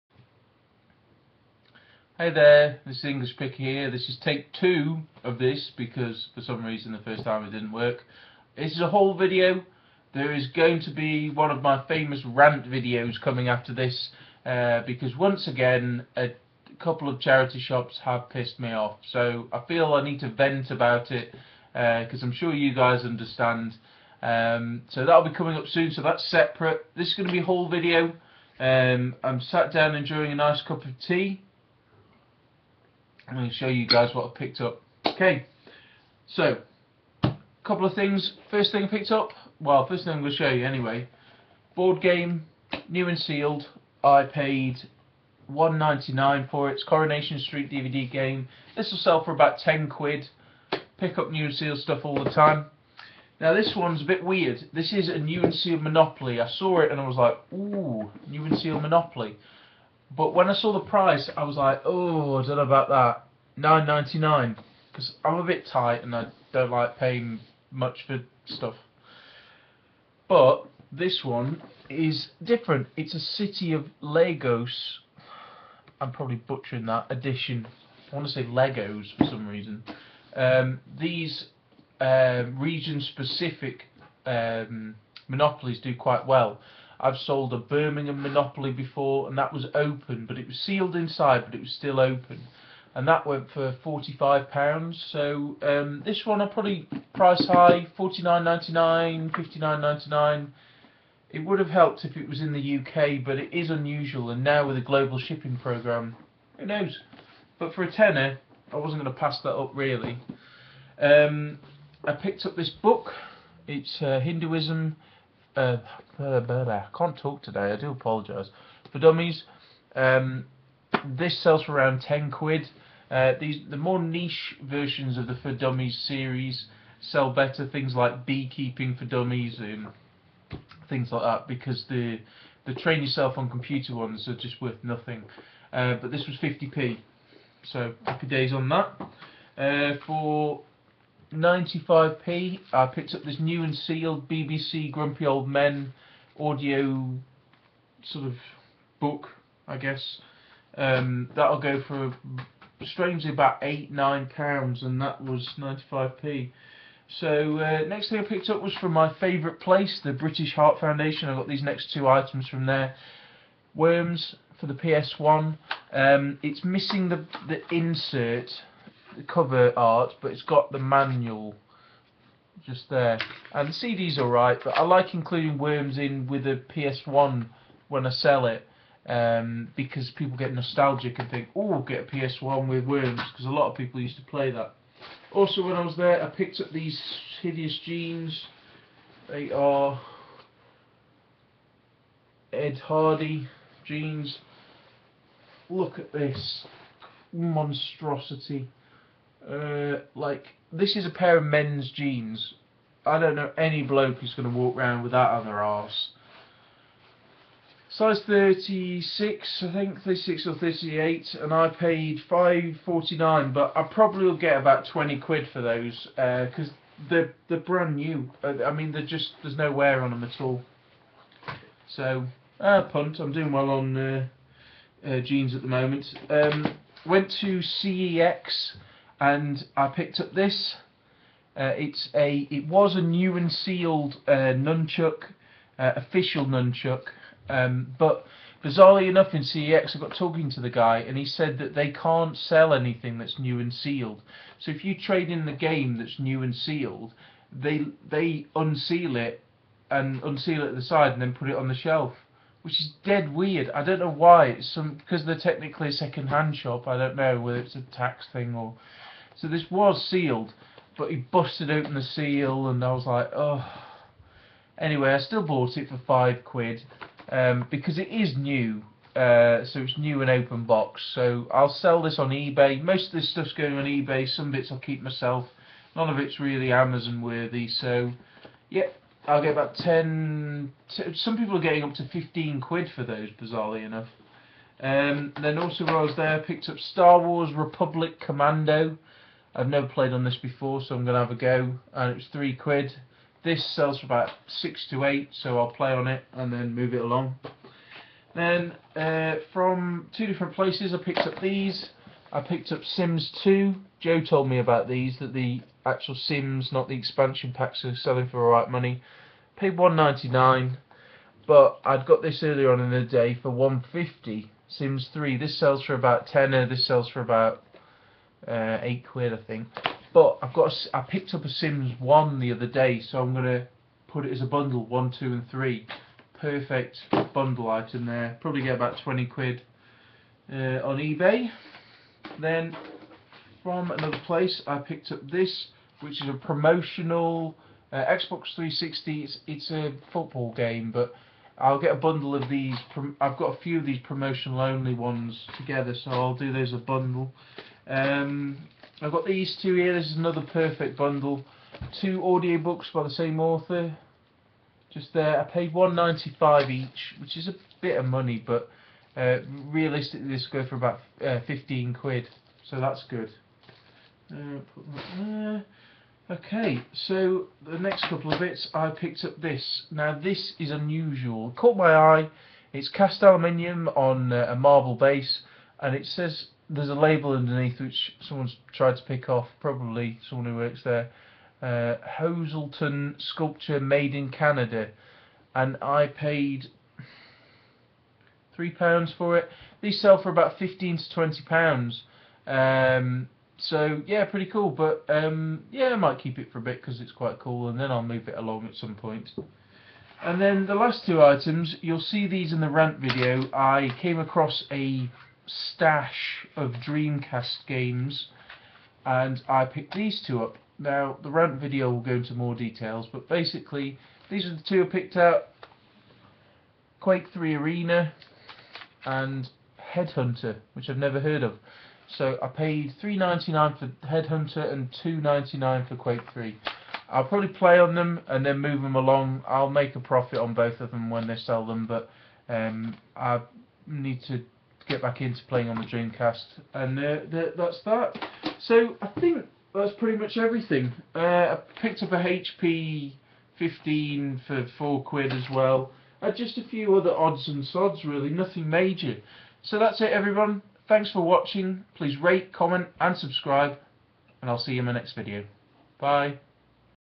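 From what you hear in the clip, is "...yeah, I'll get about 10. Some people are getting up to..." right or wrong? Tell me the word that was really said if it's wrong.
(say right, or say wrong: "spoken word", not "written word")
right.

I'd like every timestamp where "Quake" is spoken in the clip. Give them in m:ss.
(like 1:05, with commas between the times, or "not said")
6:56, 7:05.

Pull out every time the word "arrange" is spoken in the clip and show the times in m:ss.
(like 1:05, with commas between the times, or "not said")
not said.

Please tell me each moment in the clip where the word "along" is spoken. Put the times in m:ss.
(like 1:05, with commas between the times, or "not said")
4:57, 6:38, 7:08.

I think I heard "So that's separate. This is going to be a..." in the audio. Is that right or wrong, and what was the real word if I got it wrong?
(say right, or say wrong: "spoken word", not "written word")
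right.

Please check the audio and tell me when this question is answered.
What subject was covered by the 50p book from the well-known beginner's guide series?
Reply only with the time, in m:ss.
1:54.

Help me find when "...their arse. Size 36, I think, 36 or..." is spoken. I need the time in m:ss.
3:25.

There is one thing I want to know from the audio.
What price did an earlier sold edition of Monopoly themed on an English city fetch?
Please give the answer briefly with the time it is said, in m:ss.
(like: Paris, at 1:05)
£45, at 1:33.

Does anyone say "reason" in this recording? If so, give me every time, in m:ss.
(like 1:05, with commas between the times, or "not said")
0:06, 1:19.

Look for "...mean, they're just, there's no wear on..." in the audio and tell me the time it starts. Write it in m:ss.
3:38.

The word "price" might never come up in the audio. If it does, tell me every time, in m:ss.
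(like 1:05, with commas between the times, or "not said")
1:00, 1:37.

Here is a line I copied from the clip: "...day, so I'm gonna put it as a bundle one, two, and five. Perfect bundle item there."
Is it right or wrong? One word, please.
wrong.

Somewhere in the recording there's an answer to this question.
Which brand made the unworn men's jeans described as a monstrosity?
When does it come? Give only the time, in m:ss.
3:12.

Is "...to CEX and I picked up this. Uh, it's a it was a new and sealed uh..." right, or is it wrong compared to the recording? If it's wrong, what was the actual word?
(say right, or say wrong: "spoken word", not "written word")
right.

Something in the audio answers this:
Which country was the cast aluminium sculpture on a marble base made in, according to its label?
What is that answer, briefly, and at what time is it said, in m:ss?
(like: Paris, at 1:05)
Canada, at 6:24.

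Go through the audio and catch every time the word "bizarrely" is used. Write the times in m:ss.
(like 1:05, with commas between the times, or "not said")
3:58, 4:43.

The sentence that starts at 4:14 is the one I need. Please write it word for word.
It's some because they're technically a second-hand shop.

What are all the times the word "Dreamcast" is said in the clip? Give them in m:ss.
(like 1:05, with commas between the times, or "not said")
6:46, 7:15.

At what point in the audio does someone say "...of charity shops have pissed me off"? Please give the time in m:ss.
0:17.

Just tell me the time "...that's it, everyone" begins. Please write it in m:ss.
7:29.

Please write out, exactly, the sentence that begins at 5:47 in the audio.
Um, I've got these two here.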